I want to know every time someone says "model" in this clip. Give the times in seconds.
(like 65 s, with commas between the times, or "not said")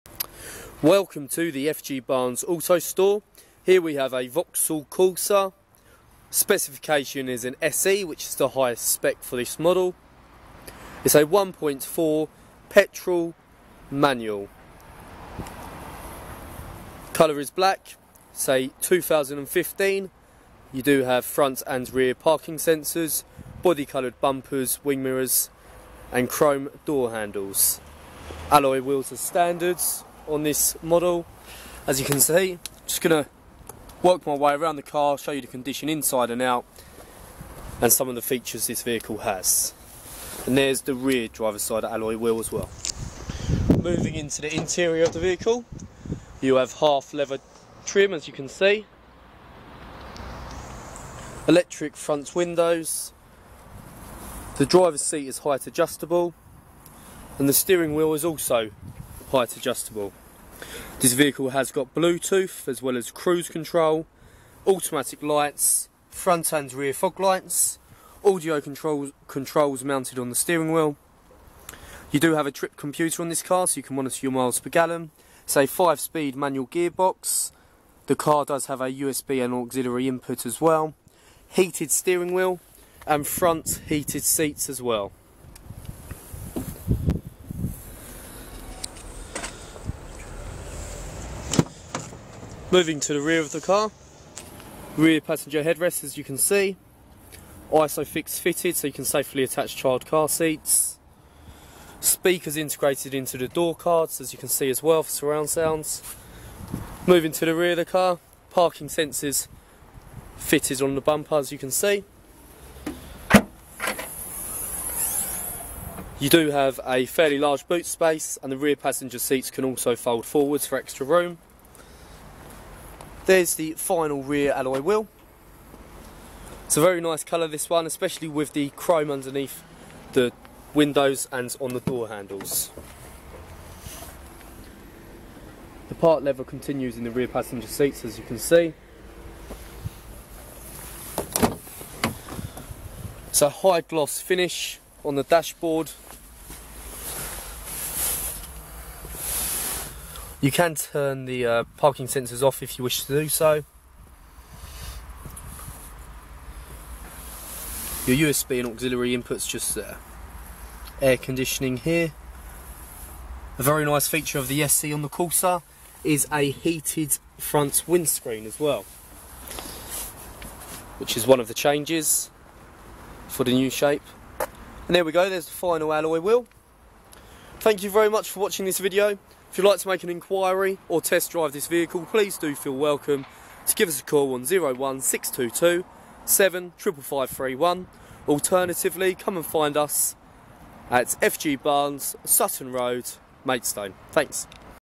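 9 s, 30 s.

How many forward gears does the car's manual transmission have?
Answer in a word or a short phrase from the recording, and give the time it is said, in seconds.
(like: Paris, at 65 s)
5, at 75 s.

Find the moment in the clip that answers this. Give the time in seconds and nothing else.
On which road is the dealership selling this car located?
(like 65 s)
192 s.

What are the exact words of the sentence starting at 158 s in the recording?
Your USB and auxiliary inputs just there.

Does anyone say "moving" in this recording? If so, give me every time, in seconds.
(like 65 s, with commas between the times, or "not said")
43 s, 92 s, 107 s.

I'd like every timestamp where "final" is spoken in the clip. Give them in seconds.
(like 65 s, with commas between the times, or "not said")
123 s, 175 s.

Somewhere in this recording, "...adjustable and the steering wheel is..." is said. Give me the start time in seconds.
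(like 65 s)
55 s.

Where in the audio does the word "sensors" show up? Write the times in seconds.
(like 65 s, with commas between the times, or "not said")
22 s, 108 s, 152 s.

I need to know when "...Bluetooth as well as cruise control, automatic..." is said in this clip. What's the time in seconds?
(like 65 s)
61 s.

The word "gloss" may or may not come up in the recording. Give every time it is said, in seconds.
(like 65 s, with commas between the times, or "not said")
143 s.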